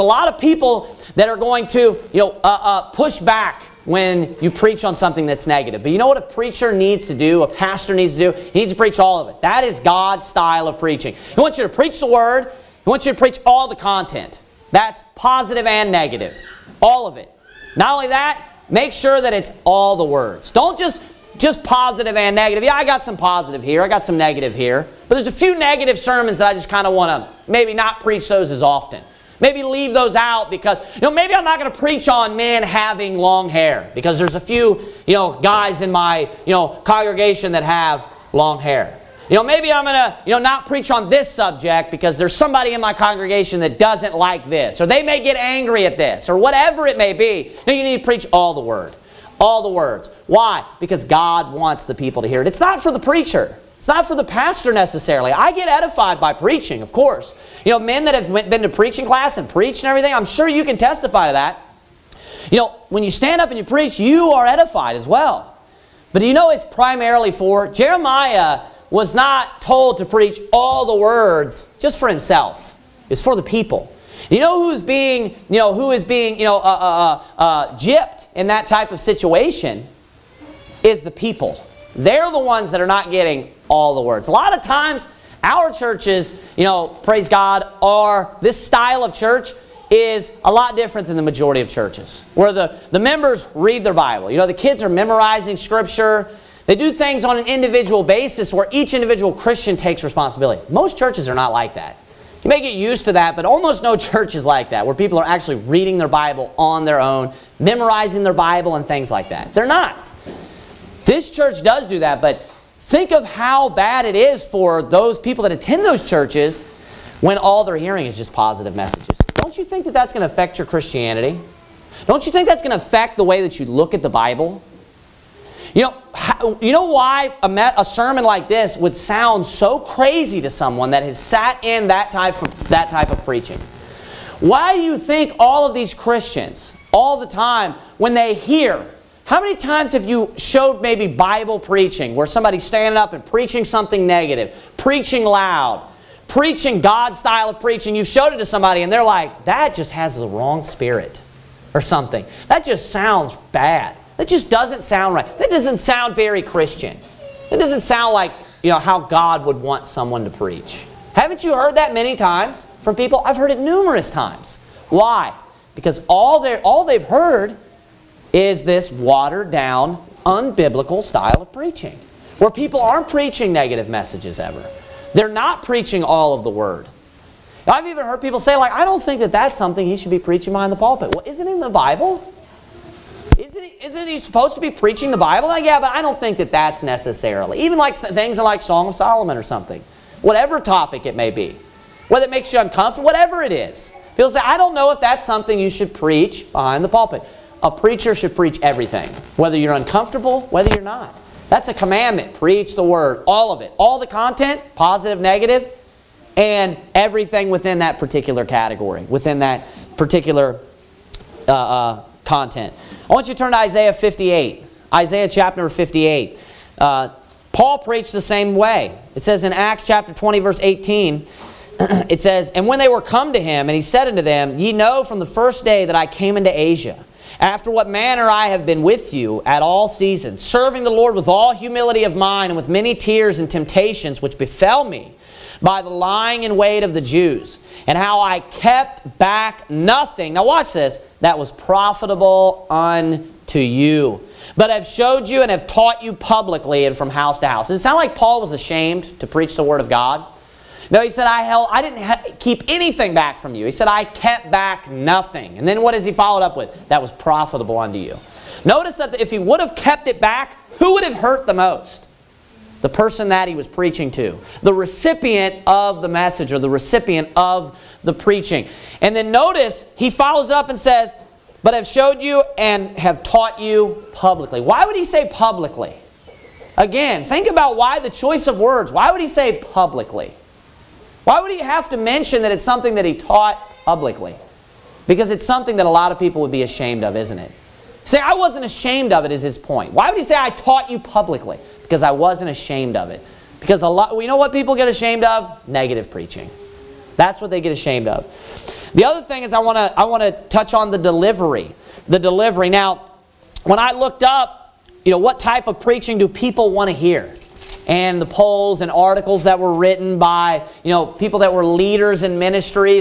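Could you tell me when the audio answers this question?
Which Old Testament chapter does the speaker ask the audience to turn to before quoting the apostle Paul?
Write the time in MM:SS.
03:33.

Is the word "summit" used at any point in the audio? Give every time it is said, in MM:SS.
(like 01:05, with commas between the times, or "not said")
not said.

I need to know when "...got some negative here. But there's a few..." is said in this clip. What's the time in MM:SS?
00:23.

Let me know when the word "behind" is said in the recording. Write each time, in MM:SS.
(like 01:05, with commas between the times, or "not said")
03:00, 03:16.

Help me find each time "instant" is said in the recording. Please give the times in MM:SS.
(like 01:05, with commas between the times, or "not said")
not said.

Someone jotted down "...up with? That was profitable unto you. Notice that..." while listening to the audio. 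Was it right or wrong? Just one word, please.
right.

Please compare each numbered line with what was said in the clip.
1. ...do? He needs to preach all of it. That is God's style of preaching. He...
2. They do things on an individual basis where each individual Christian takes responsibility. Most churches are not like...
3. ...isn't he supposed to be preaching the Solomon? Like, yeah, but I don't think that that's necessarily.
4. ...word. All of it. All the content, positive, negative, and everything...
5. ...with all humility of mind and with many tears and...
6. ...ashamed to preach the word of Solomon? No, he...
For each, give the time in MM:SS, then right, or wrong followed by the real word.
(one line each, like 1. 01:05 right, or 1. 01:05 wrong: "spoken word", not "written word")
1. 00:08 right
2. 01:36 right
3. 03:03 wrong: "Bible", not "Solomon"
4. 03:22 right
5. 03:51 right
6. 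04:08 wrong: "God", not "Solomon".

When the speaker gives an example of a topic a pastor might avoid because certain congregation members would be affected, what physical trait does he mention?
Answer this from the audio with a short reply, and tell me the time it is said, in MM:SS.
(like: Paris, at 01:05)
Men having long hair, at 00:32.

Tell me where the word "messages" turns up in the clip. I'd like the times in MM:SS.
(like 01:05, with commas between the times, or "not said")
01:58, 02:53, 04:26.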